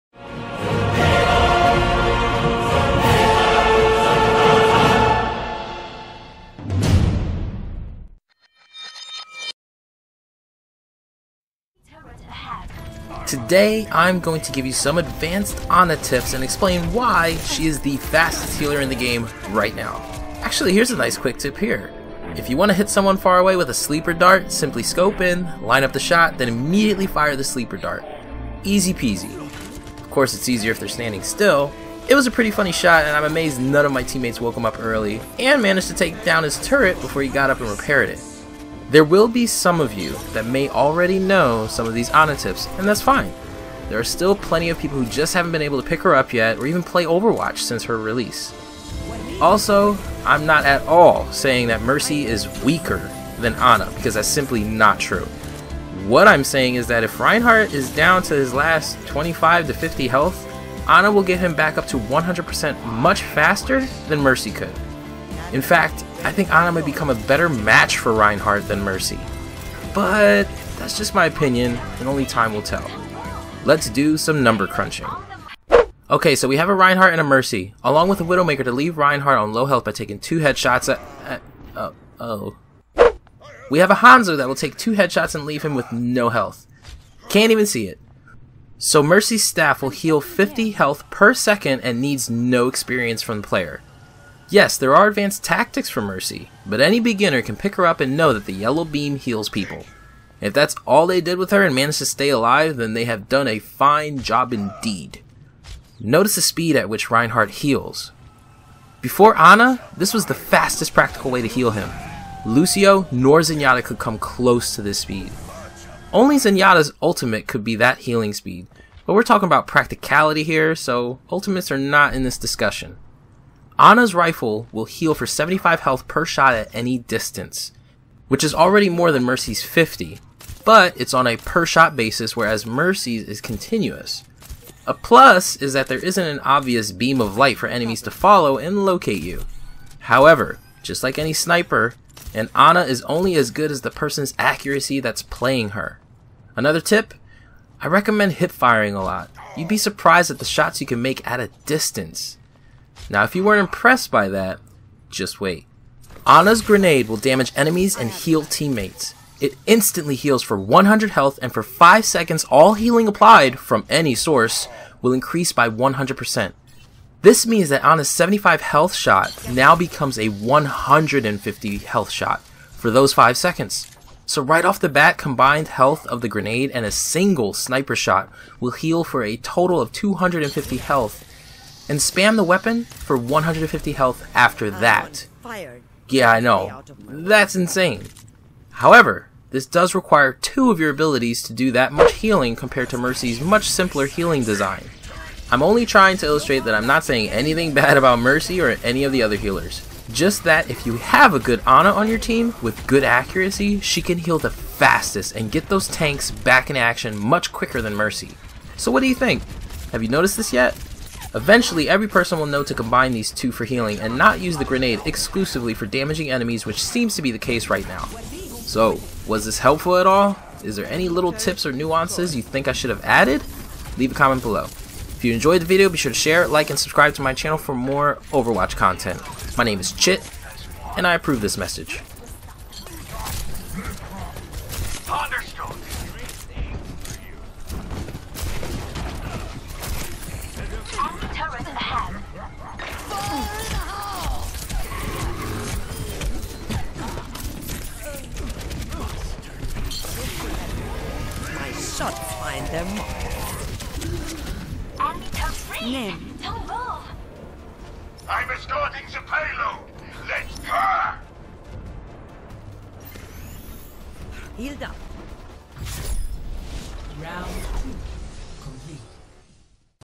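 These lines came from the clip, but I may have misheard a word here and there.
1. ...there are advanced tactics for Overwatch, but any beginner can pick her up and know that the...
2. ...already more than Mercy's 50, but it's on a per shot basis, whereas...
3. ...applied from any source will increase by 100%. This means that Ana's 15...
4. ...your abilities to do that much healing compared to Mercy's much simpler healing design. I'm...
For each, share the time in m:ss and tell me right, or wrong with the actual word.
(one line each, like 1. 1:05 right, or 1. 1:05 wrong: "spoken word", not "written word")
1. 1:34 wrong: "Mercy", not "Overwatch"
2. 2:08 right
3. 2:43 wrong: "75", not "15"
4. 3:10 right.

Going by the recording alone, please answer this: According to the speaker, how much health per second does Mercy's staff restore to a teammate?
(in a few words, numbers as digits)
50.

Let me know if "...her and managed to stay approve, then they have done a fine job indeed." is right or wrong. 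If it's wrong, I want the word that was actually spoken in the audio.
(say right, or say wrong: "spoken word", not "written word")
wrong: "alive", not "approve".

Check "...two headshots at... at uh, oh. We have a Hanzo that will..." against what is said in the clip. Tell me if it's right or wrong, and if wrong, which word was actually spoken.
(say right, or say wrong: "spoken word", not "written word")
right.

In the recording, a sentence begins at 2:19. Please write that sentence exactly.
However, just like any sniper, and Ana is only as good as the person's accuracy that's playing her.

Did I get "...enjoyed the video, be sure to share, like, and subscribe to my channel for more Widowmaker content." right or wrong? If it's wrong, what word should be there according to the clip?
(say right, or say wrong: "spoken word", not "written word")
wrong: "Overwatch", not "Widowmaker".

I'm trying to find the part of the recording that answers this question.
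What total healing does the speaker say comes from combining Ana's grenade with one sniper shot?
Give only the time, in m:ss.
2:59.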